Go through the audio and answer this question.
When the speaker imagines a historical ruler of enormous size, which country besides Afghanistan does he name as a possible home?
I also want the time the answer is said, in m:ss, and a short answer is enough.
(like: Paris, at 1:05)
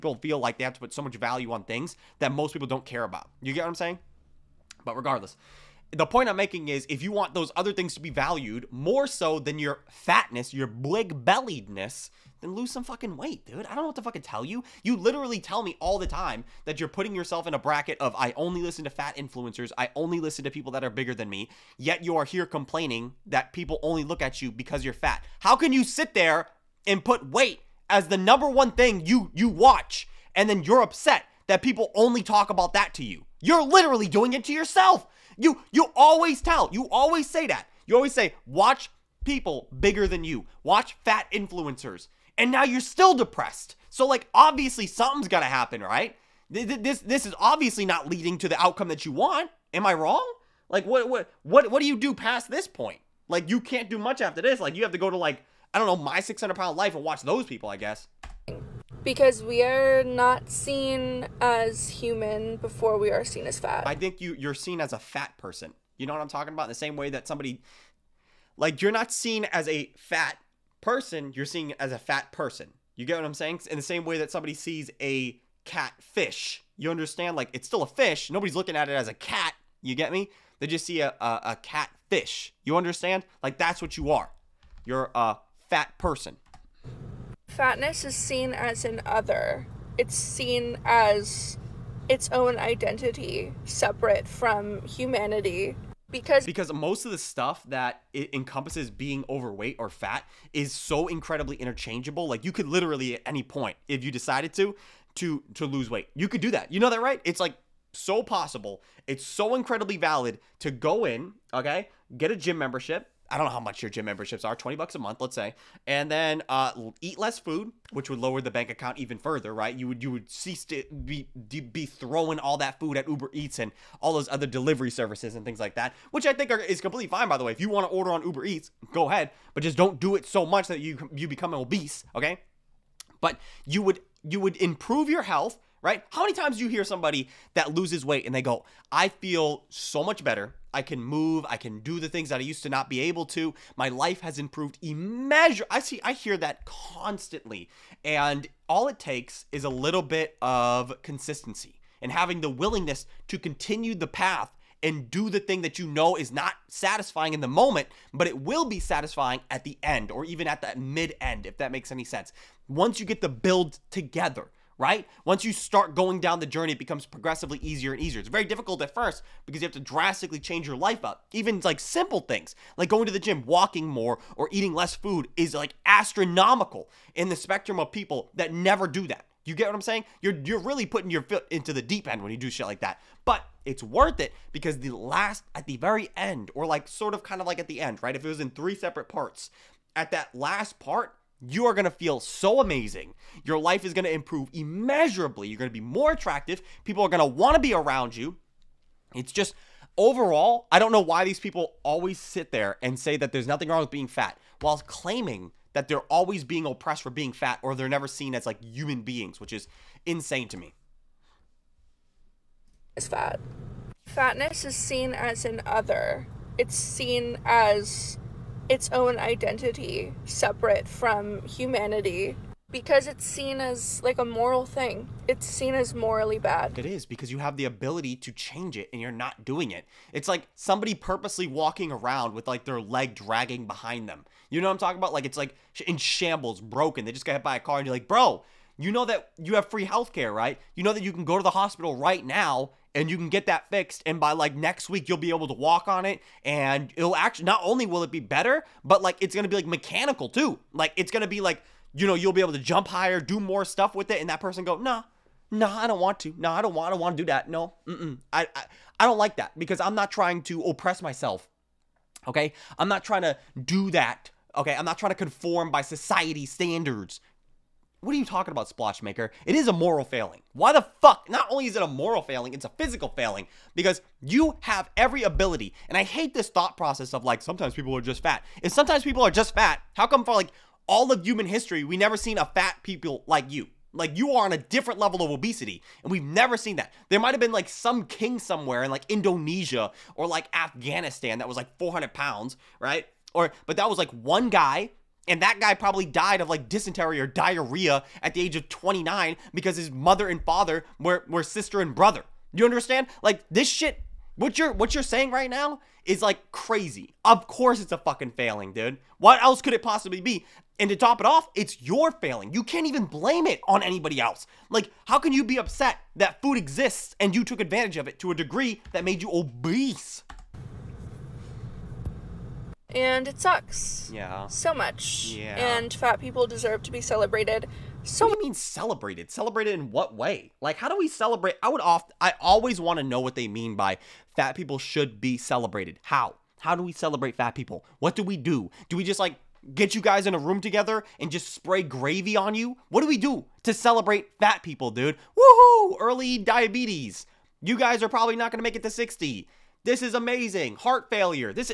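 Indonesia, at 4:49.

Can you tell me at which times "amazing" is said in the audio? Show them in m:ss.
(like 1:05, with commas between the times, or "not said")
3:12, 5:50.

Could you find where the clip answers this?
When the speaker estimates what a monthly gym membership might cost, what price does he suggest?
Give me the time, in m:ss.
1:54.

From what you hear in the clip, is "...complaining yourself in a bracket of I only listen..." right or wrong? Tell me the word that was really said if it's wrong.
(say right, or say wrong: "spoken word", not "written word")
wrong: "putting", not "complaining".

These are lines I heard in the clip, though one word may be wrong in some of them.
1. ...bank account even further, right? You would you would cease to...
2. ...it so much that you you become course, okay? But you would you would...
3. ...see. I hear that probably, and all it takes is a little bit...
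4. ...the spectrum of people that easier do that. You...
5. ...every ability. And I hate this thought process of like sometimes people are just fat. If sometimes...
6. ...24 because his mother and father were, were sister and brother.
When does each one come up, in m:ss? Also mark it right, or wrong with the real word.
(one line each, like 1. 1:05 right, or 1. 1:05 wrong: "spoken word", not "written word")
1. 1:58 right
2. 2:10 wrong: "obese", not "course"
3. 2:25 wrong: "constantly", not "probably"
4. 2:57 wrong: "never", not "easier"
5. 4:34 right
6. 4:58 wrong: "29", not "24".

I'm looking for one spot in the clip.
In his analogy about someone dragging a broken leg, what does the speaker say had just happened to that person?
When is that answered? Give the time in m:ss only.
3:57.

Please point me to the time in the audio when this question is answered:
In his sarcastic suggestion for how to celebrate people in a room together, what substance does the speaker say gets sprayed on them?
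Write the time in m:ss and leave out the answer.
5:41.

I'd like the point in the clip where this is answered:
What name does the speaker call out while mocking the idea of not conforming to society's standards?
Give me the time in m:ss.
4:28.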